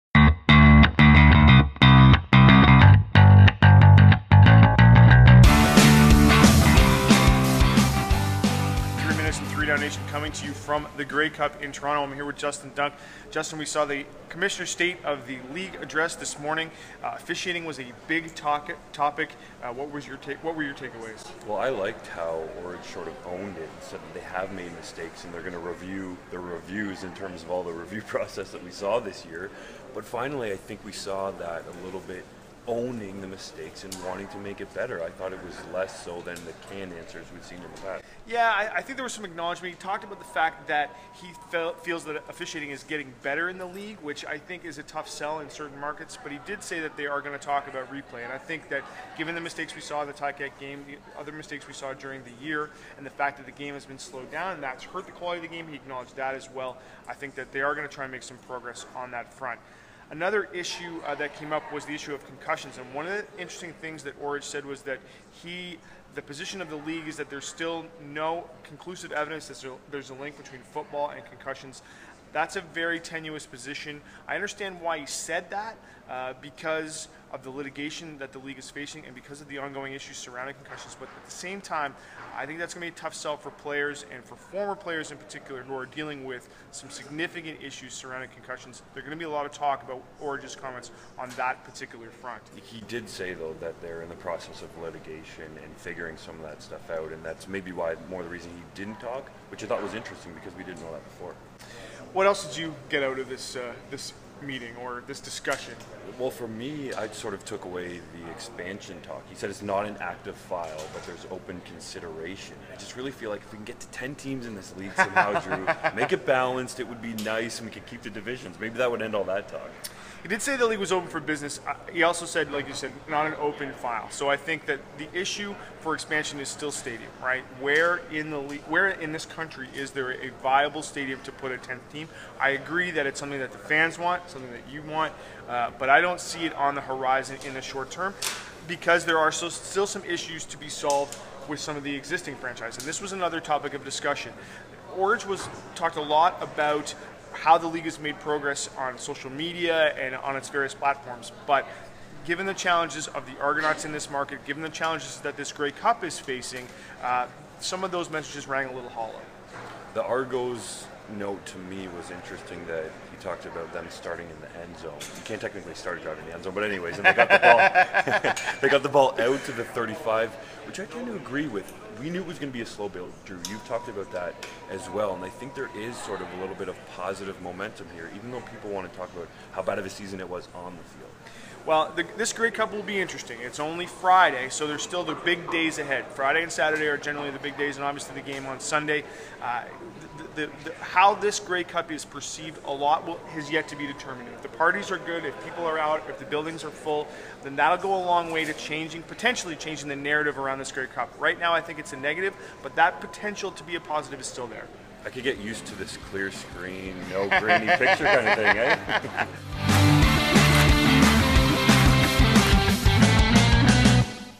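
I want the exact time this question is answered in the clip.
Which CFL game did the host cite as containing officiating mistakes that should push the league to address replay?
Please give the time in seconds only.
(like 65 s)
50 s.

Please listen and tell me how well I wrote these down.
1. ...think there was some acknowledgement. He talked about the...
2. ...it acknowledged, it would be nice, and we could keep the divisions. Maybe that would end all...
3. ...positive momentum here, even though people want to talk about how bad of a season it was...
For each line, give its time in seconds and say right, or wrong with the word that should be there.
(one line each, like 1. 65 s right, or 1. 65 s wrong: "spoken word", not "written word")
1. 38 s right
2. 116 s wrong: "balanced", not "acknowledged"
3. 176 s right.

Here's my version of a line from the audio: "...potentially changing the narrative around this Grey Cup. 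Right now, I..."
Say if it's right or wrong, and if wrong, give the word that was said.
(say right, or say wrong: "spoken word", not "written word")
right.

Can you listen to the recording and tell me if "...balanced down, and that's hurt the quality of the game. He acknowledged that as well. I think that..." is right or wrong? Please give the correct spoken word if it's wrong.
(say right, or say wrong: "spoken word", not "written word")
wrong: "slowed", not "balanced".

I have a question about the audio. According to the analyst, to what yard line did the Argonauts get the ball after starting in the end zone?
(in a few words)
35.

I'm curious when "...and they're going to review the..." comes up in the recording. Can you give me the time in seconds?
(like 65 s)
25 s.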